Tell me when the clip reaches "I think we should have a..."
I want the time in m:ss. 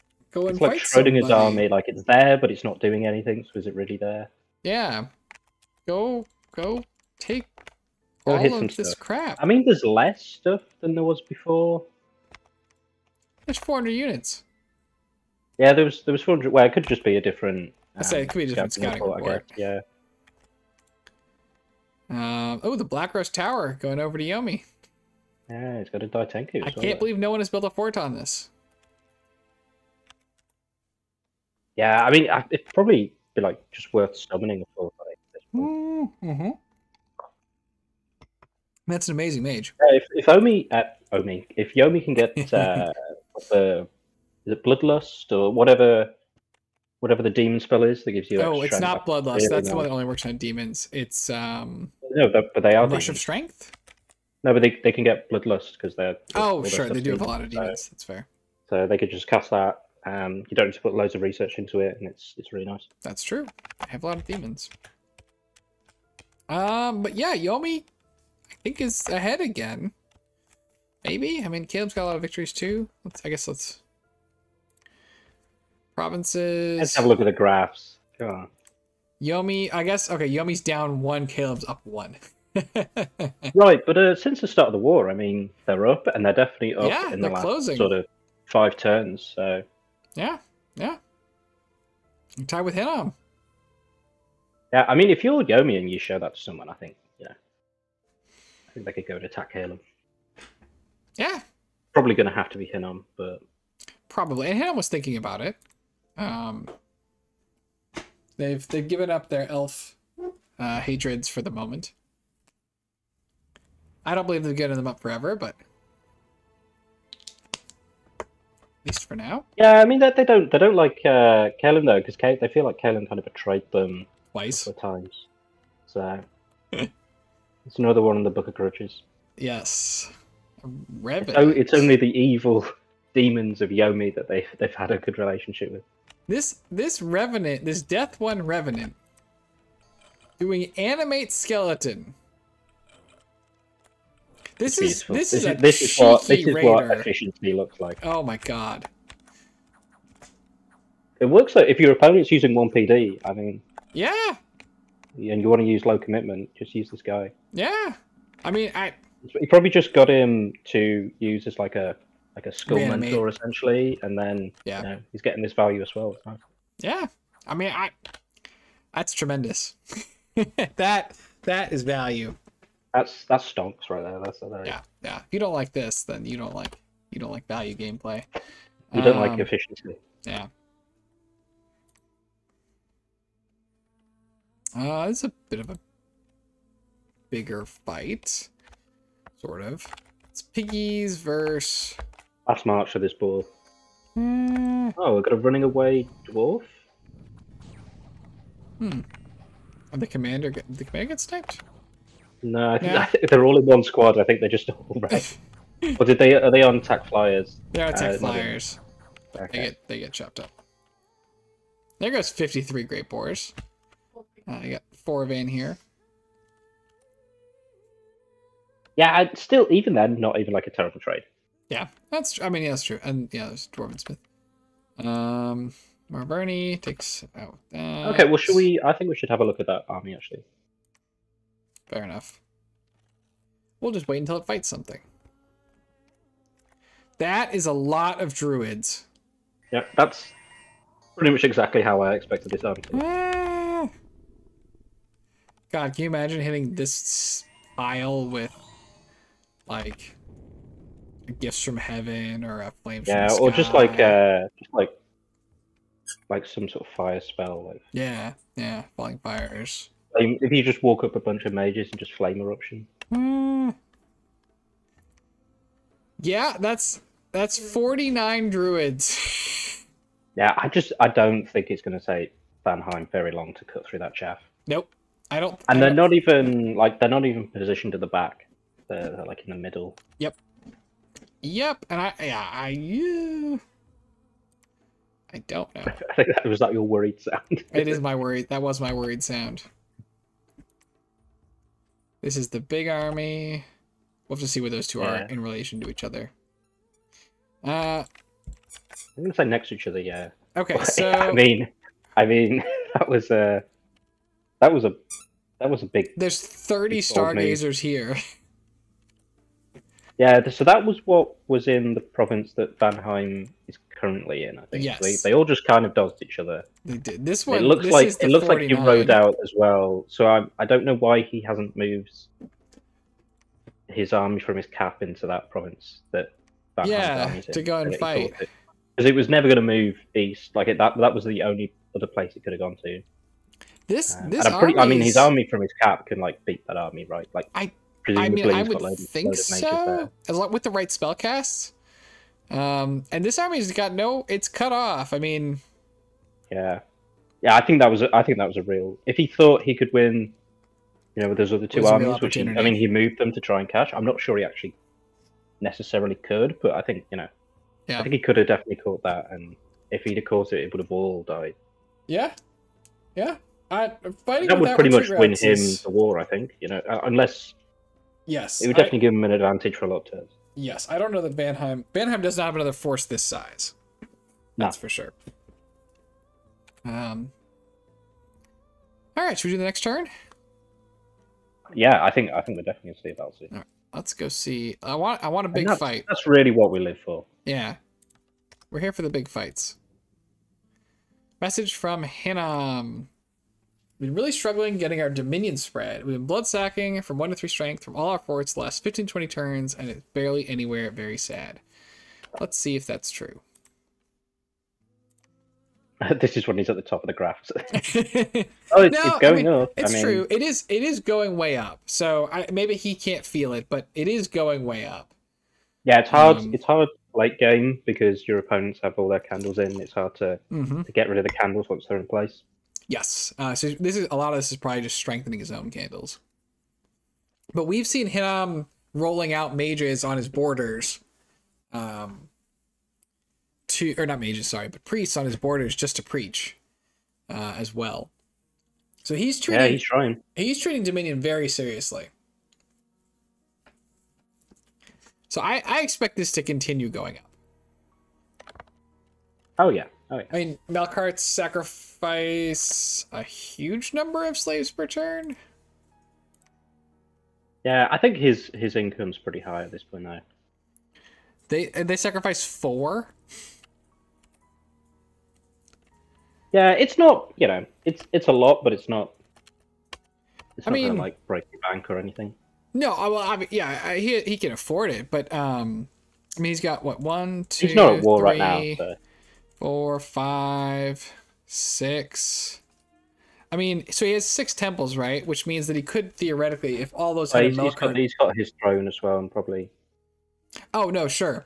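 3:48.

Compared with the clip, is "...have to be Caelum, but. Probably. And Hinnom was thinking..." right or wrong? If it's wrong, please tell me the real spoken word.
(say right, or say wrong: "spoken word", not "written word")
wrong: "Hinnom", not "Caelum".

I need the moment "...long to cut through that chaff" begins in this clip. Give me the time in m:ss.
4:33.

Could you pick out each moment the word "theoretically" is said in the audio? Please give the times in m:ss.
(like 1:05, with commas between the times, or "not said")
8:06.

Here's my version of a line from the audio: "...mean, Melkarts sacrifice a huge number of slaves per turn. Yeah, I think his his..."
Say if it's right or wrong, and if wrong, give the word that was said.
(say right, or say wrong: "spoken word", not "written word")
right.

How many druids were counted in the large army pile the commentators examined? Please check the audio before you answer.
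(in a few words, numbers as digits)
49.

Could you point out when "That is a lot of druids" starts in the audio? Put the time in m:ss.
3:57.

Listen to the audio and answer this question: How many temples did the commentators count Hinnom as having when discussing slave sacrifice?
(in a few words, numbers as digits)
6.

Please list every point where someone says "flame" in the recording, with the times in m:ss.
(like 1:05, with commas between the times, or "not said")
4:12, 4:22.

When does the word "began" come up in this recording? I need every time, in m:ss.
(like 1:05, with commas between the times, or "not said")
not said.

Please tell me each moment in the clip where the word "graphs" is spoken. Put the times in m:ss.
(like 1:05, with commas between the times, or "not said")
1:17, 6:47.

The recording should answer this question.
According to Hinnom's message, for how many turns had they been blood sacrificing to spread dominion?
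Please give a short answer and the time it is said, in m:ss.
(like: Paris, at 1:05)
15 20, at 6:38.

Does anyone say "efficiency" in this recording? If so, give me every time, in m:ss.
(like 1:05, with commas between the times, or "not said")
2:26, 2:59.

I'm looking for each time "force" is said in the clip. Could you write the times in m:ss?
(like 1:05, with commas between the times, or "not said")
6:12.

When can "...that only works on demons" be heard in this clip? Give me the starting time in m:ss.
0:49.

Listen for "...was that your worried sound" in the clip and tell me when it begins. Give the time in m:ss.
4:46.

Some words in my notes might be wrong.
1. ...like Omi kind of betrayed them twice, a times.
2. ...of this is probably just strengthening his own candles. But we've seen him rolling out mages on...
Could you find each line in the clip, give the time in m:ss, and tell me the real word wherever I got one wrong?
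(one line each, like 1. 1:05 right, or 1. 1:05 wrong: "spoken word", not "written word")
1. 2:02 wrong: "Caelum", not "Omi"
2. 7:04 right.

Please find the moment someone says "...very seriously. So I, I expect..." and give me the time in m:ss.
7:21.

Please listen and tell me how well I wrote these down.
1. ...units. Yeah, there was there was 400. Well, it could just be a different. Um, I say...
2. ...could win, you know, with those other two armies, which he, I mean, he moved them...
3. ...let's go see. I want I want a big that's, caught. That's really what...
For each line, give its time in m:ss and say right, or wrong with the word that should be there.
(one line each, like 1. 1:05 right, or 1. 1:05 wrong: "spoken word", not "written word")
1. 0:13 right
2. 5:49 right
3. 6:23 wrong: "fight", not "caught".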